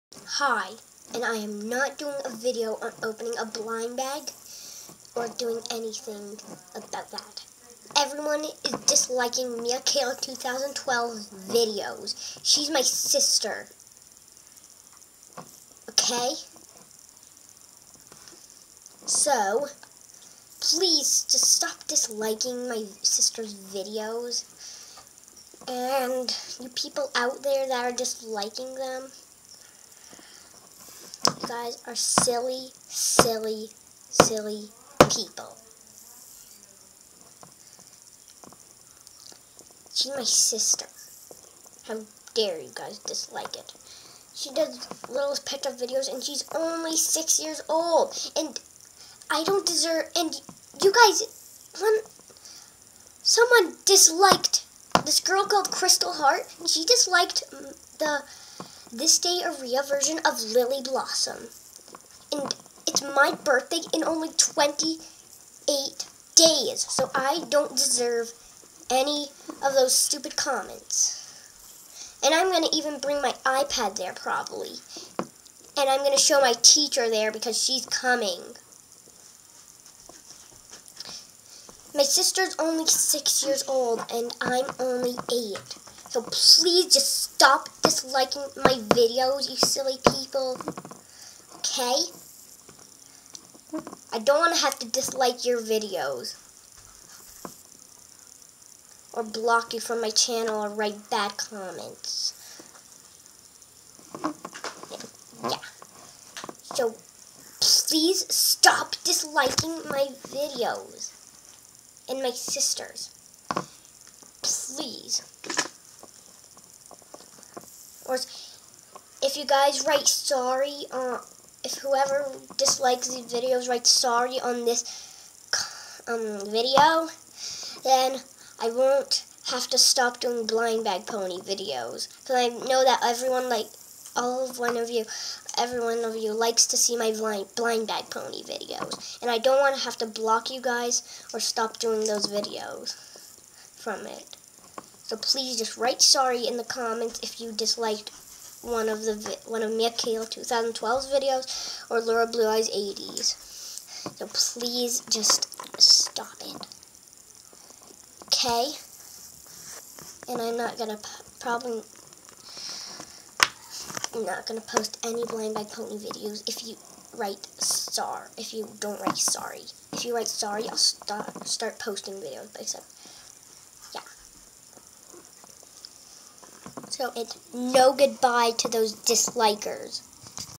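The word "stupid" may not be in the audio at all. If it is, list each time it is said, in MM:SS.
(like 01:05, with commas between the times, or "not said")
01:09.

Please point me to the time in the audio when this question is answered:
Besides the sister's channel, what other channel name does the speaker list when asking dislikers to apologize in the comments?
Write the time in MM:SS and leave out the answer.
02:31.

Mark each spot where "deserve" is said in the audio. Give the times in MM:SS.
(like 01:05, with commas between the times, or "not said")
00:49, 01:07.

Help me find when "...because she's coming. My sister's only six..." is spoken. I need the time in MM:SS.
01:17.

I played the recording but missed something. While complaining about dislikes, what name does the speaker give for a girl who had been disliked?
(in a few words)
Crystal Heart.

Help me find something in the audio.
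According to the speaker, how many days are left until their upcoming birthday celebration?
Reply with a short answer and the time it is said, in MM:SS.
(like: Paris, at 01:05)
28 days, at 01:04.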